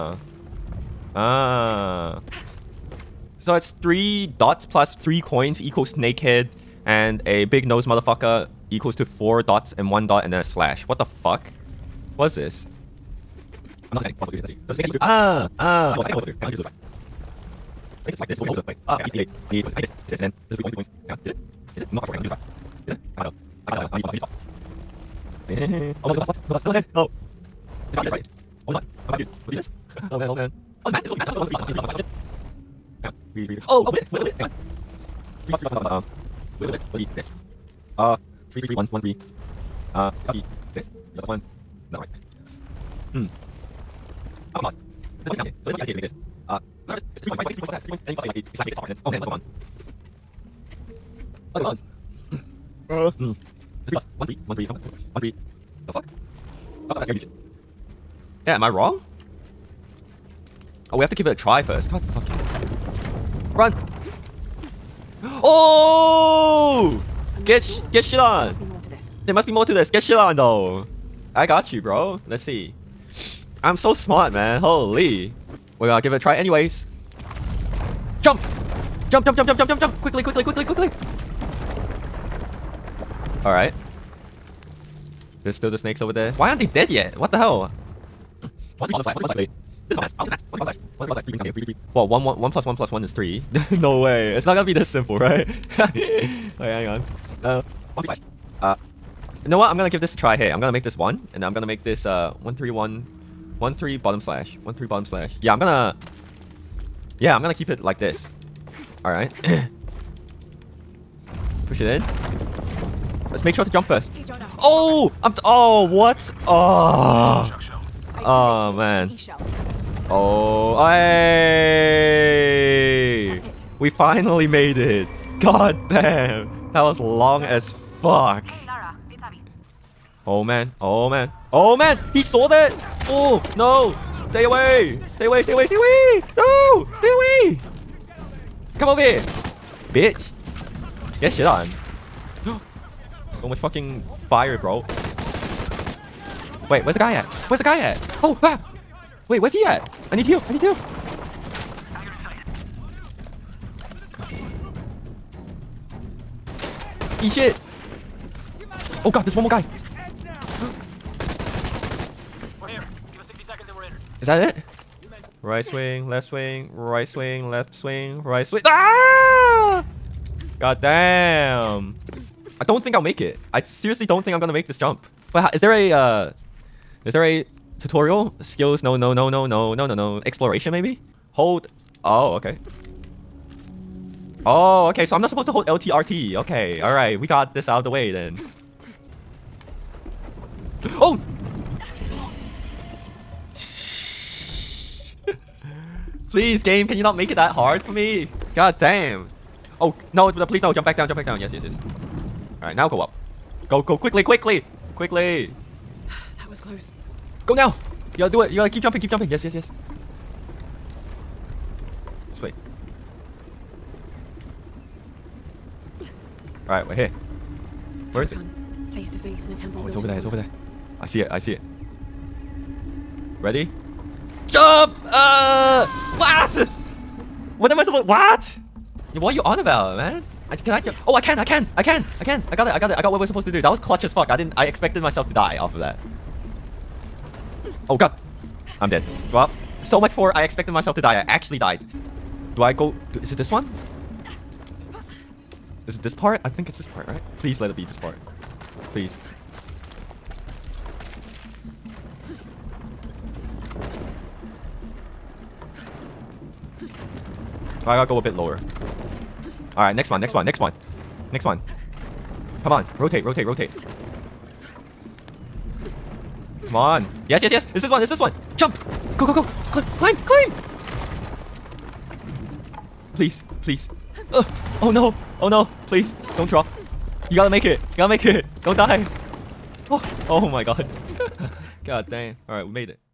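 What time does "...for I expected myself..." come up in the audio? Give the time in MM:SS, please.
04:00.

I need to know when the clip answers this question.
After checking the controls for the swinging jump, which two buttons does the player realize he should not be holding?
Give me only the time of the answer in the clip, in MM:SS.
03:05.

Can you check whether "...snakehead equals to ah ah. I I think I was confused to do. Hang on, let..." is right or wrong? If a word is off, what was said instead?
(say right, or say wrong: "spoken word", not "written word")
wrong: "supposed", not "confused".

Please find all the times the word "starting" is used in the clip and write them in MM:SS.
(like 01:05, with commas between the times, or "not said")
not said.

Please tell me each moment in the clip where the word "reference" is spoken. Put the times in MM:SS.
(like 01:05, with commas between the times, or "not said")
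not said.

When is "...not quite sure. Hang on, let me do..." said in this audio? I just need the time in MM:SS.
00:21.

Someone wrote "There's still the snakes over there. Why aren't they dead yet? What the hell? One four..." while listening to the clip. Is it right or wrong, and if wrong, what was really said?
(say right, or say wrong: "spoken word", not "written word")
wrong: "three", not "four".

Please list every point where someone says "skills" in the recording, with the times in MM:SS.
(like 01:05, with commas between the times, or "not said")
02:58.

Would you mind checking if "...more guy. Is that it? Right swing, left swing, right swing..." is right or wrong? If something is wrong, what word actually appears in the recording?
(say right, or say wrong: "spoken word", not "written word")
right.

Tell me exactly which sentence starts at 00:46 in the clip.
Uh, I'm sure this, it's, it's three points, right?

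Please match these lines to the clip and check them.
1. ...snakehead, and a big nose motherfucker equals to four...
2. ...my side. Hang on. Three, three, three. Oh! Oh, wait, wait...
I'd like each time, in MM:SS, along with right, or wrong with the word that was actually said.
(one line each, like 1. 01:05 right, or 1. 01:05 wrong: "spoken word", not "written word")
1. 00:05 right
2. 00:31 right.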